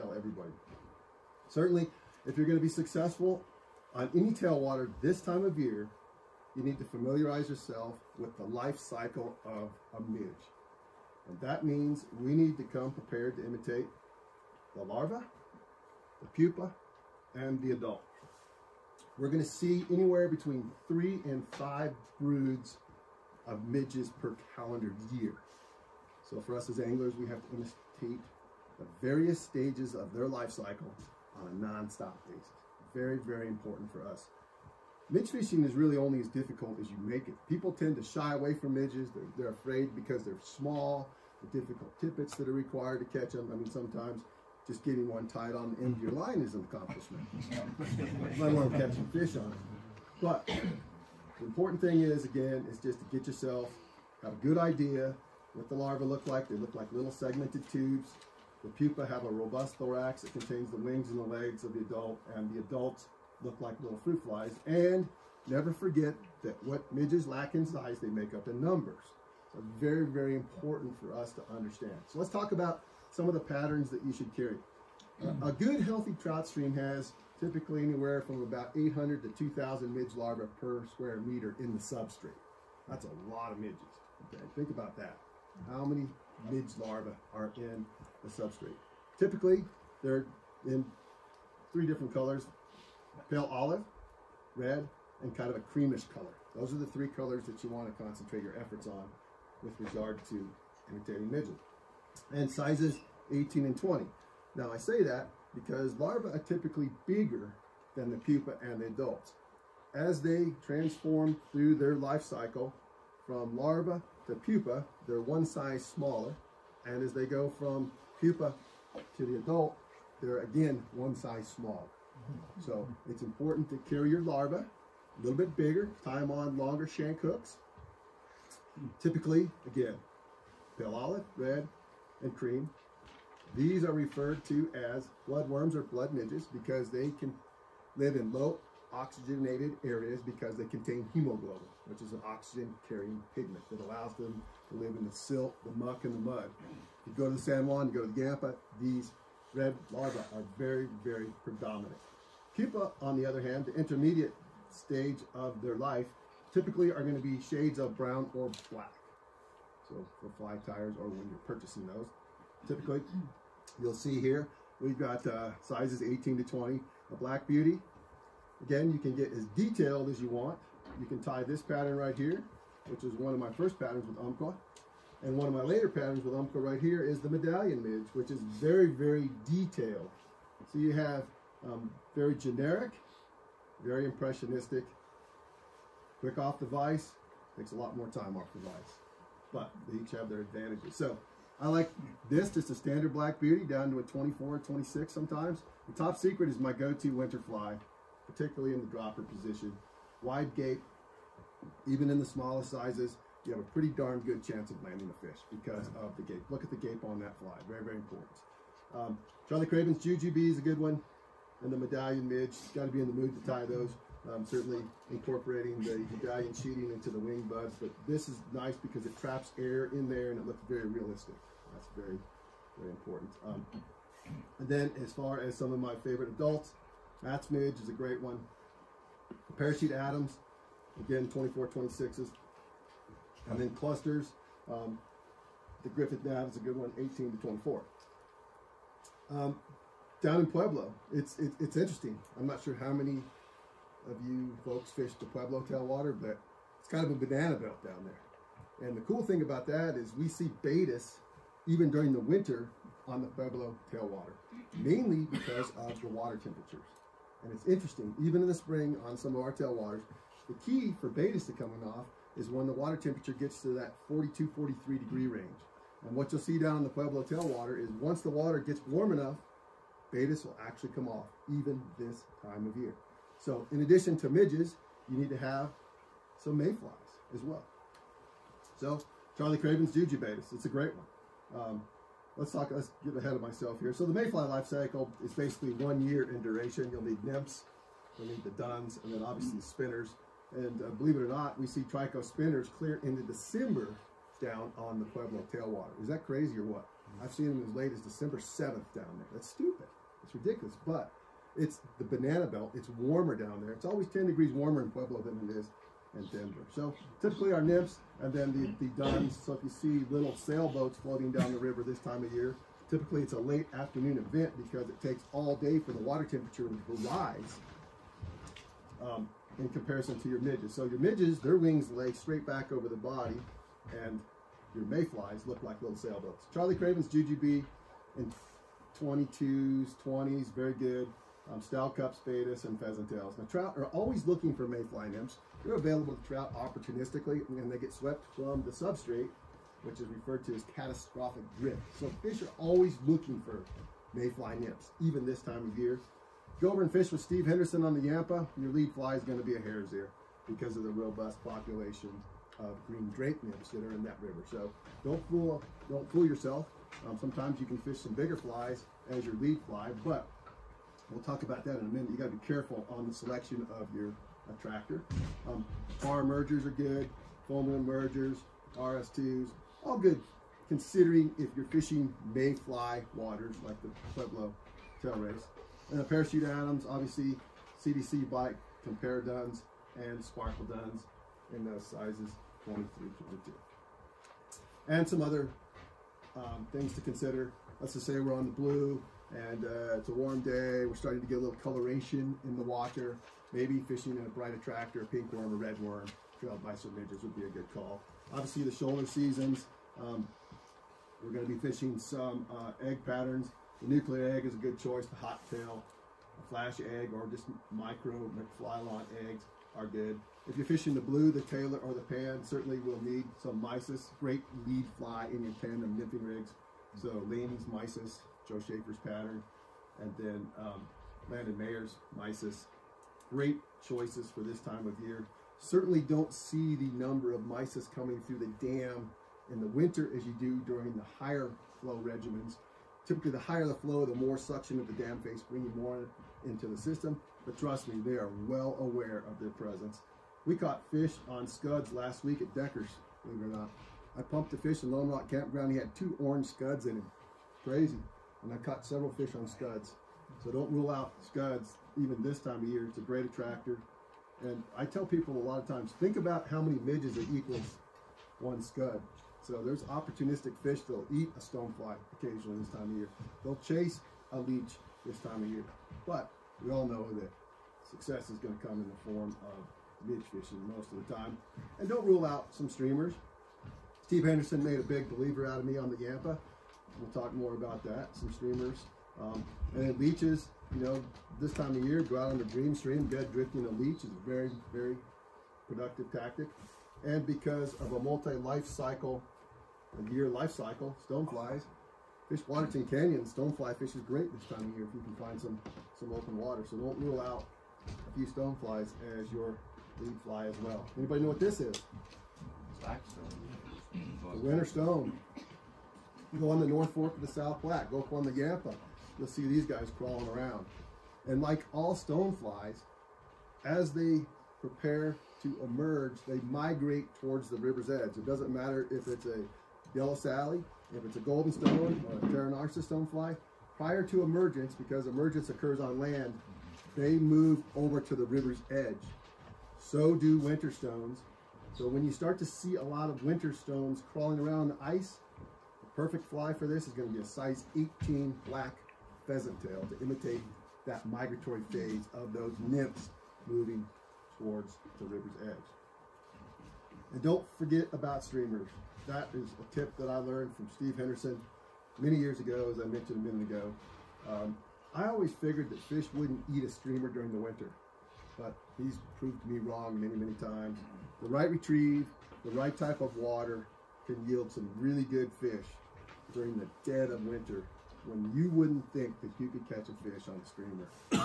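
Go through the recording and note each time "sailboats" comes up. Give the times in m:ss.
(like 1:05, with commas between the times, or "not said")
5:10, 5:25.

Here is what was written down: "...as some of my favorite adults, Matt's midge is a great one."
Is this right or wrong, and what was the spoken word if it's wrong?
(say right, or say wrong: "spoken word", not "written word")
right.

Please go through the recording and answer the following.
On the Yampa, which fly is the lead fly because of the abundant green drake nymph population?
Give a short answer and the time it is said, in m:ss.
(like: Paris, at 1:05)
hare's ear, at 5:49.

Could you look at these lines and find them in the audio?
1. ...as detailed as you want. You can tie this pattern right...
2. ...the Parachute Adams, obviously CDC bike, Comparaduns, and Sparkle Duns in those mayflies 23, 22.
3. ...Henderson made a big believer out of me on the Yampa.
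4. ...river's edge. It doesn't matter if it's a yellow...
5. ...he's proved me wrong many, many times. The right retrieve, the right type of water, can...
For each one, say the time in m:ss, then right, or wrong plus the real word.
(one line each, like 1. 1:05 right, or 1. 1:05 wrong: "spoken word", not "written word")
1. 2:49 right
2. 6:15 wrong: "sizes", not "mayflies"
3. 7:54 right
4. 8:37 right
5. 9:18 right.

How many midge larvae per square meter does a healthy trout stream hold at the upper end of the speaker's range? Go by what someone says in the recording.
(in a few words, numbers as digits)
2,000.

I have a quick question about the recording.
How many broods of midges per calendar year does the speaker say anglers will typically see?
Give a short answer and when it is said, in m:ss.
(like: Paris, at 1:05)
3 to 5, at 0:20.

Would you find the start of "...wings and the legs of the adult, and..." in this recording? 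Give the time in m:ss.
1:00.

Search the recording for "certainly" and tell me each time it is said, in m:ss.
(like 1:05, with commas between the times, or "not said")
0:01, 3:34, 6:52, 7:05.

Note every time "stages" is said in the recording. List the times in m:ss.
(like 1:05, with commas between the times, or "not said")
0:29, 2:34.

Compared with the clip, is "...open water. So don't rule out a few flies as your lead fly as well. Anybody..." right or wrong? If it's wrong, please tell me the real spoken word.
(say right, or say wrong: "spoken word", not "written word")
wrong: "stoneflies", not "flies".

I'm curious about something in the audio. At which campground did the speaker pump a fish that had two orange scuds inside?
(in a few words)
Lone Rock Campground.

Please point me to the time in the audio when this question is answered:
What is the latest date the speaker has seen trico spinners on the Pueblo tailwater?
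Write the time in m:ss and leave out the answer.
4:57.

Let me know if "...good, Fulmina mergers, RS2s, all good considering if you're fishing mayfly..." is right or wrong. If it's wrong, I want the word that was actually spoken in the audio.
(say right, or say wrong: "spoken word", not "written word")
right.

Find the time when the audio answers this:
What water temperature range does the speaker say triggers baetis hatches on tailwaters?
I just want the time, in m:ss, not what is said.
4:24.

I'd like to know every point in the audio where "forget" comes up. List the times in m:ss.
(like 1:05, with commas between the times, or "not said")
1:05, 9:07.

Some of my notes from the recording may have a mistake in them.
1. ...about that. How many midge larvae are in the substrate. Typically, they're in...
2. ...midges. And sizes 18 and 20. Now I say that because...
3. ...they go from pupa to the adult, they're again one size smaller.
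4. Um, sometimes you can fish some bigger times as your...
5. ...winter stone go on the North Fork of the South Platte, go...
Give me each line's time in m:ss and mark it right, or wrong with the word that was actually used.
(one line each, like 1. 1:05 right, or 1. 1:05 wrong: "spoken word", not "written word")
1. 1:24 right
2. 1:41 right
3. 1:57 right
4. 5:57 wrong: "flies", not "times"
5. 8:24 right.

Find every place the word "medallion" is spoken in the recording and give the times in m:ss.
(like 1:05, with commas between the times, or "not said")
2:57, 3:31, 3:36.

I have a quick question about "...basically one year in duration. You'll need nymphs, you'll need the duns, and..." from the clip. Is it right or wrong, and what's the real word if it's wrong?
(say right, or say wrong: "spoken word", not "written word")
right.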